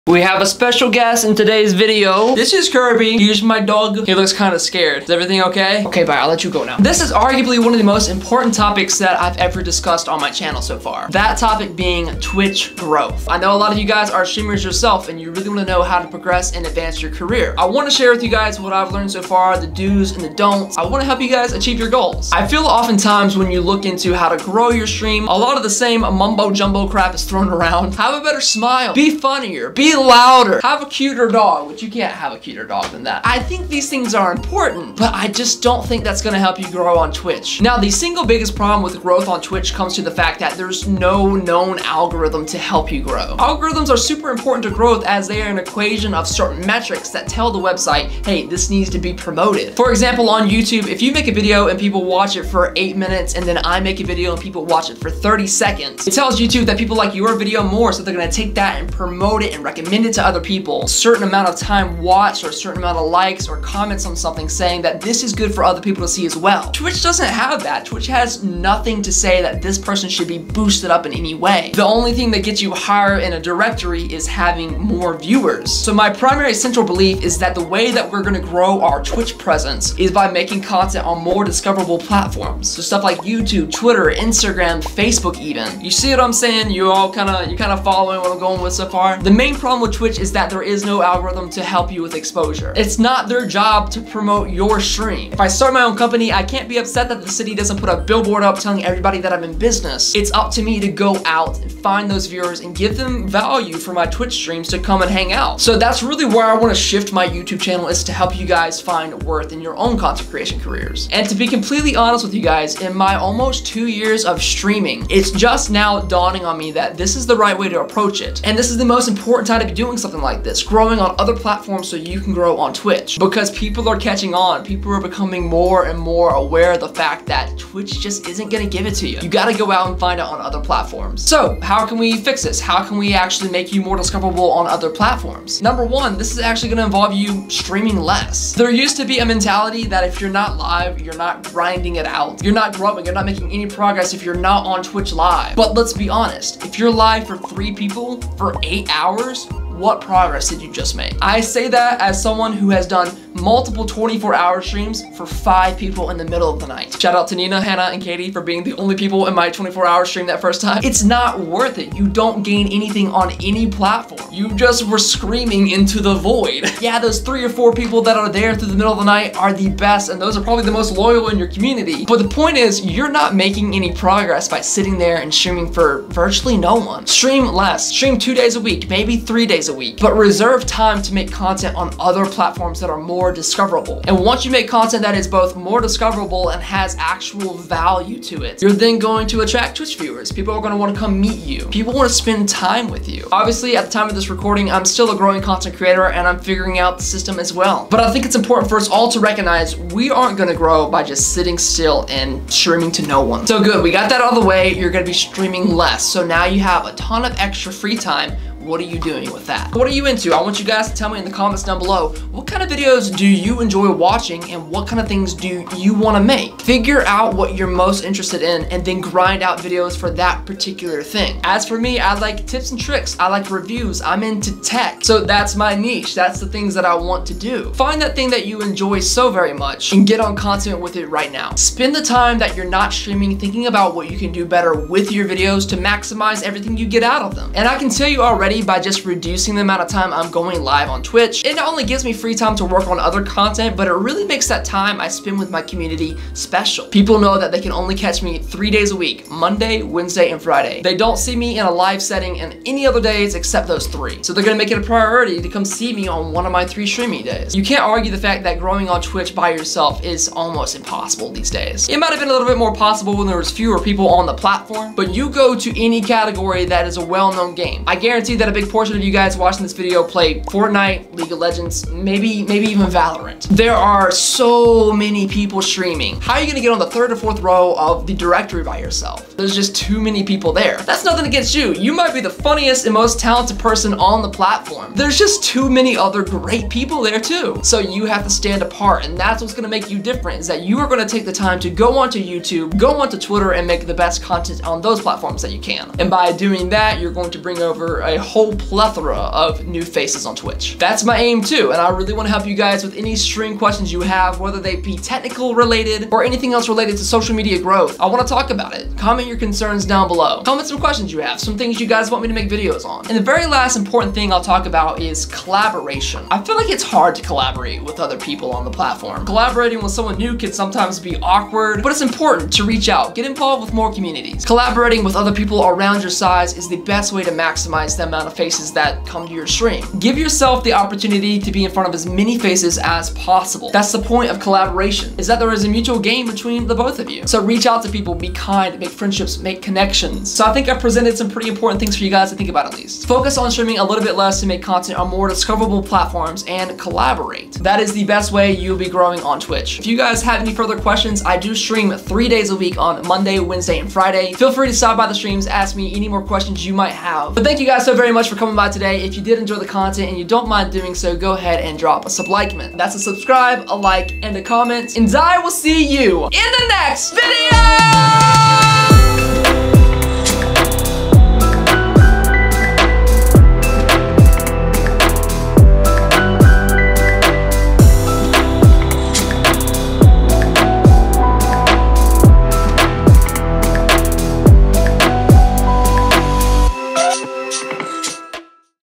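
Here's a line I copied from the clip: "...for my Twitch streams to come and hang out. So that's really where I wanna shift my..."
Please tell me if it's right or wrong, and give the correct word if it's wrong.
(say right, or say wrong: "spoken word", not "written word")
right.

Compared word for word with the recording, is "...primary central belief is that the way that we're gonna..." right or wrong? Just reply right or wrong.
right.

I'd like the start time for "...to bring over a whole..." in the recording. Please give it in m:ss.
4:57.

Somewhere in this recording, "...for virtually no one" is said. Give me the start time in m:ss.
2:55.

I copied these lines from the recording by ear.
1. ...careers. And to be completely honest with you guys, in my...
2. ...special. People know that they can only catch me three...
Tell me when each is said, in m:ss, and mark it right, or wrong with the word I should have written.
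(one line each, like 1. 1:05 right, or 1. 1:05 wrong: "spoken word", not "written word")
1. 1:50 right
2. 4:06 right.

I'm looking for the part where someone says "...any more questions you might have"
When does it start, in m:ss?
5:55.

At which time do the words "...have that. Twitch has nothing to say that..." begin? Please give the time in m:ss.
1:07.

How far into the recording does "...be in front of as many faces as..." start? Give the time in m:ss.
5:31.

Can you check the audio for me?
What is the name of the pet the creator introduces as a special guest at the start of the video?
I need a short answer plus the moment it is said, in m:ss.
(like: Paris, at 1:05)
Kirby, at 0:02.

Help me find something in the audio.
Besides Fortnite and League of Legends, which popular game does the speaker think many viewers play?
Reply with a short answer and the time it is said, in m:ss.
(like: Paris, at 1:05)
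Valorant, at 4:32.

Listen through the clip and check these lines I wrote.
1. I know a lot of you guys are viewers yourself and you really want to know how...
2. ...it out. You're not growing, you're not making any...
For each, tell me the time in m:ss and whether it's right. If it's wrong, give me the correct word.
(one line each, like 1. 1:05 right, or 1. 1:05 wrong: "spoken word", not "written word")
1. 0:13 wrong: "streamers", not "viewers"
2. 2:21 right.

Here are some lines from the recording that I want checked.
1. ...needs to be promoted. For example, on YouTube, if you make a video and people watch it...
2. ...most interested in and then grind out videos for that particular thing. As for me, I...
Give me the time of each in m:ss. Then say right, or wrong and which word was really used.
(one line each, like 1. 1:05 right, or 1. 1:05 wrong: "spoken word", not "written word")
1. 0:48 right
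2. 3:37 right.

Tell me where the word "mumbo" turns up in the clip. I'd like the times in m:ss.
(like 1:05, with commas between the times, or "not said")
0:26.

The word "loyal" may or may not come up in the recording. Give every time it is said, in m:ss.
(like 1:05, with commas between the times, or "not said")
2:50.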